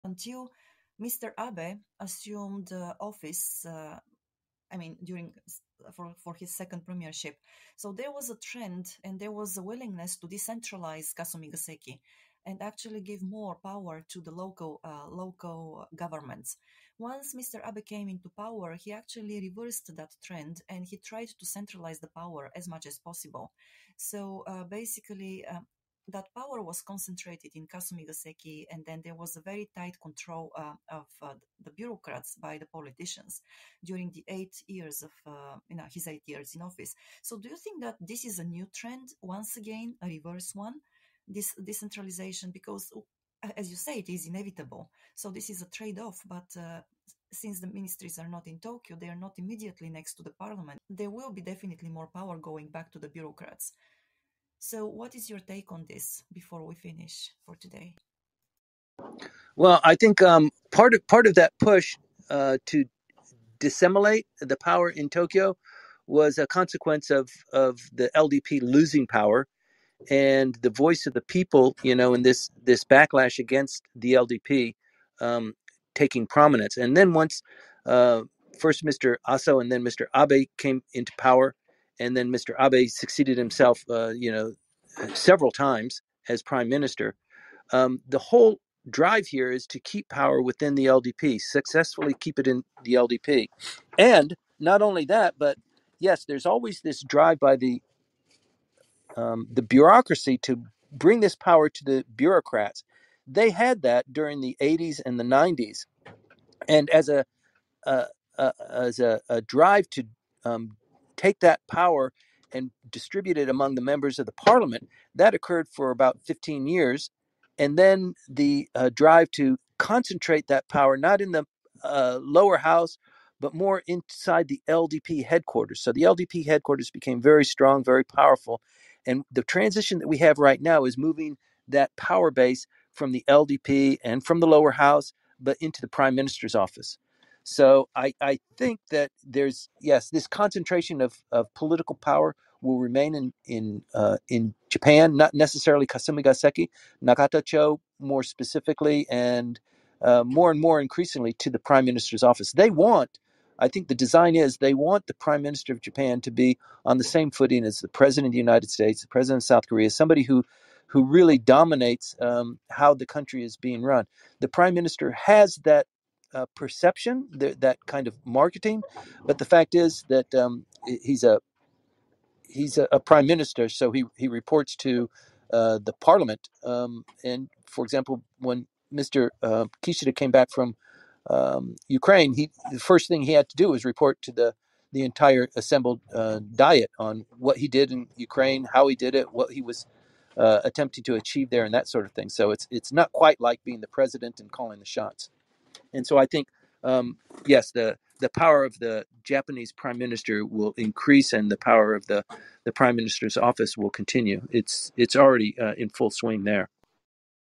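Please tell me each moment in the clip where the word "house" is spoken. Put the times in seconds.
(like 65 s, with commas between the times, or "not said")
122 s, 134 s.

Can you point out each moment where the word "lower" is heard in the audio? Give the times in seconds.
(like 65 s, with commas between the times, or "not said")
122 s, 134 s.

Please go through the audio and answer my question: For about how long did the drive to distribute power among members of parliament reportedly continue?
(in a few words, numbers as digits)
15 years.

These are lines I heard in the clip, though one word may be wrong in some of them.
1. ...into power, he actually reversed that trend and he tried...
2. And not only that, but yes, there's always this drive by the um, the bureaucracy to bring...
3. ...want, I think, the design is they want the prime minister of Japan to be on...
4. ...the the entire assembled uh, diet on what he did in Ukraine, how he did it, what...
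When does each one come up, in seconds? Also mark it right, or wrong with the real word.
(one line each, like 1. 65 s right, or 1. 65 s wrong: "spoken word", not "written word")
1. 18 s right
2. 93 s right
3. 152 s right
4. 184 s right.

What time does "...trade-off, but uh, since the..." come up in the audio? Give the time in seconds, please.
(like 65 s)
45 s.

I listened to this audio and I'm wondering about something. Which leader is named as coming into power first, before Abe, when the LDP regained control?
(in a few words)
Aso.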